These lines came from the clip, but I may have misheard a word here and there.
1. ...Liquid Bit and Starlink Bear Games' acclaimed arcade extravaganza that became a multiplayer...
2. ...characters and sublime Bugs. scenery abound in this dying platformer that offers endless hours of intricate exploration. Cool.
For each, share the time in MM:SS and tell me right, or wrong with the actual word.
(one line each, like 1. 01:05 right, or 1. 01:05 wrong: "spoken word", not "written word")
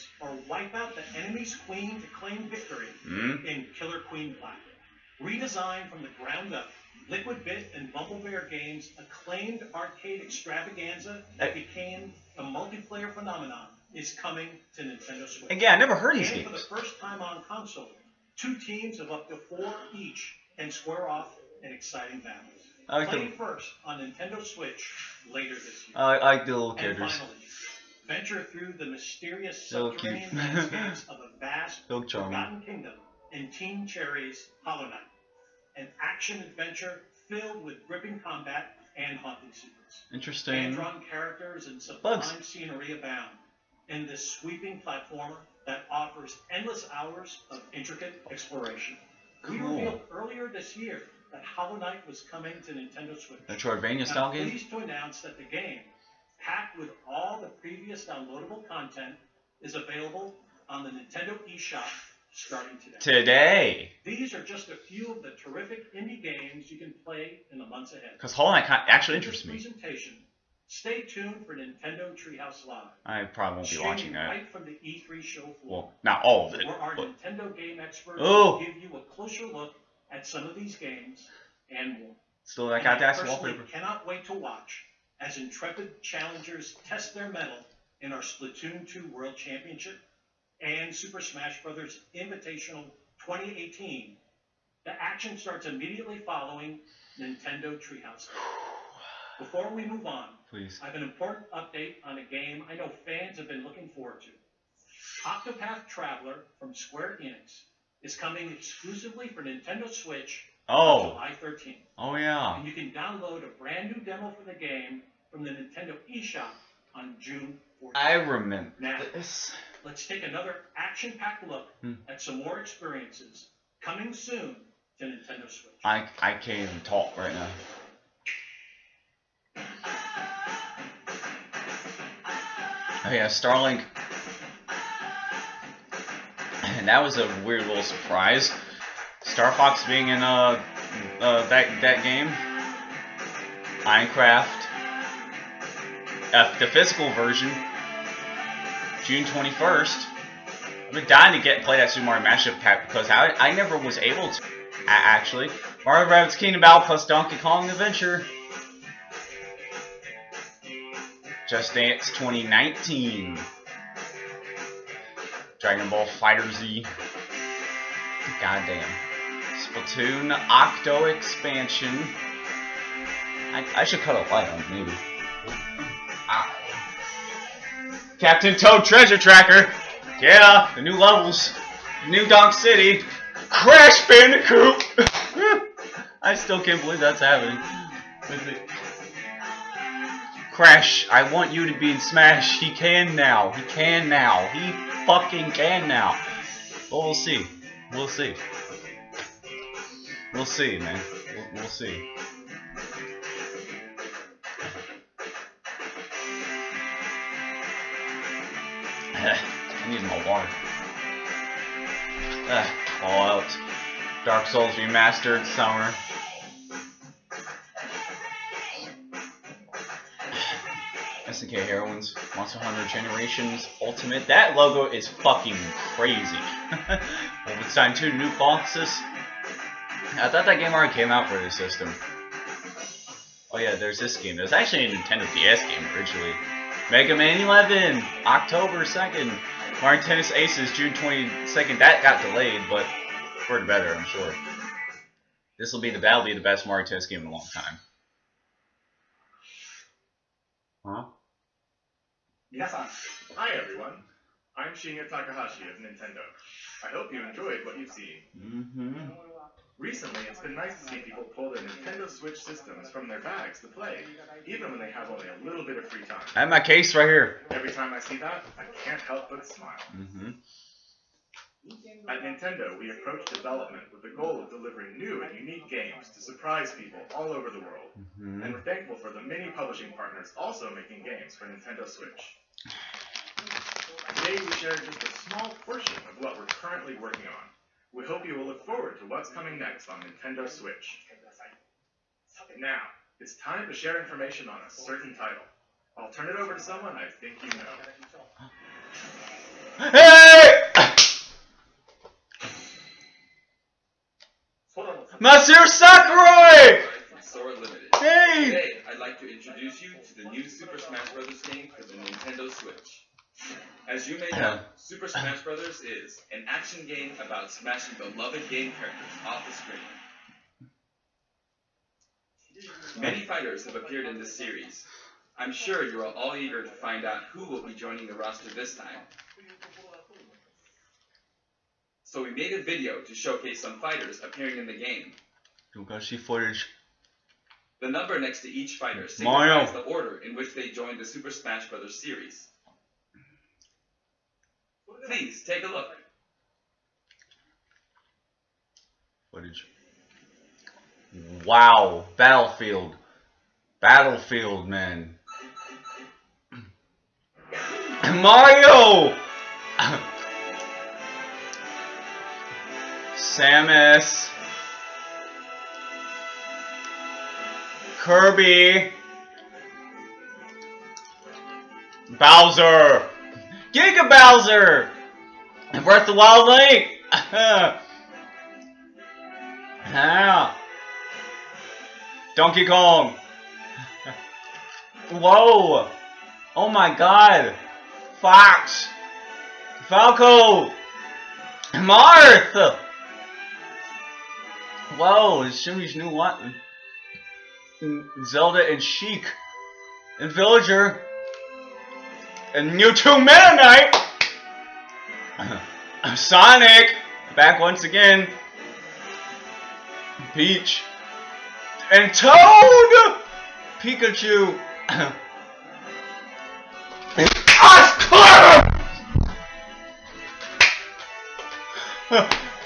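1. 00:07 wrong: "Bumble", not "Starlink"
2. 00:41 wrong: "sweeping", not "dying".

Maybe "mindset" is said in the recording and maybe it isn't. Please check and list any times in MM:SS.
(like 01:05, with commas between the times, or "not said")
not said.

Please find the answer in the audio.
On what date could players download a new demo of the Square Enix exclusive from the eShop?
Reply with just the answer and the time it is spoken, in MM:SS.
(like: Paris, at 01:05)
June 14th, at 01:57.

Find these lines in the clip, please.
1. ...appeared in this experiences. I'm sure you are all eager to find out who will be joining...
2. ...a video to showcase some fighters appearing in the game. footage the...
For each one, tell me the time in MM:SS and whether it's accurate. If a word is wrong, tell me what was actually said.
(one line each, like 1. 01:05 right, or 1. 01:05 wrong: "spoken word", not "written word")
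1. 05:23 wrong: "series", not "experiences"
2. 05:32 right.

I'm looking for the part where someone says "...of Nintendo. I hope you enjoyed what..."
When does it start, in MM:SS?
04:15.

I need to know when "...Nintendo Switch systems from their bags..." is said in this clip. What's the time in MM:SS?
04:21.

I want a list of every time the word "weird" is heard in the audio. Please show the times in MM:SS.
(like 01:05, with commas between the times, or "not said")
02:17.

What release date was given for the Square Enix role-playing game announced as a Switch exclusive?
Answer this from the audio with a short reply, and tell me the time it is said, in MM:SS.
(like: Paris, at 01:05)
July 13th, at 01:51.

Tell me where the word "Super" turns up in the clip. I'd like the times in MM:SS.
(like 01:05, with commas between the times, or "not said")
01:30, 02:31, 05:10, 05:14, 05:41.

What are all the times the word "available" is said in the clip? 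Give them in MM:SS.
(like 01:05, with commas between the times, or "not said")
00:59.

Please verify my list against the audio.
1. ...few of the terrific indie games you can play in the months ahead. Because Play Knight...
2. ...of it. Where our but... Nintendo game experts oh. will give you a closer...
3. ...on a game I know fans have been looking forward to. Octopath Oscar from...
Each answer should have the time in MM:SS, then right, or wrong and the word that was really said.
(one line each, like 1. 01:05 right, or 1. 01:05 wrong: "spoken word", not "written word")
1. 01:04 wrong: "Hollow", not "Play"
2. 01:16 right
3. 01:42 wrong: "Traveler", not "Oscar".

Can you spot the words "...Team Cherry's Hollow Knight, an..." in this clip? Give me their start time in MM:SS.
00:33.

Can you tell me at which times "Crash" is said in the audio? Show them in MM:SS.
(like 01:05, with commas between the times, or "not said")
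03:03, 03:10.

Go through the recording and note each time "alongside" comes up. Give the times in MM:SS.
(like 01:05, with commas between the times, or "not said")
not said.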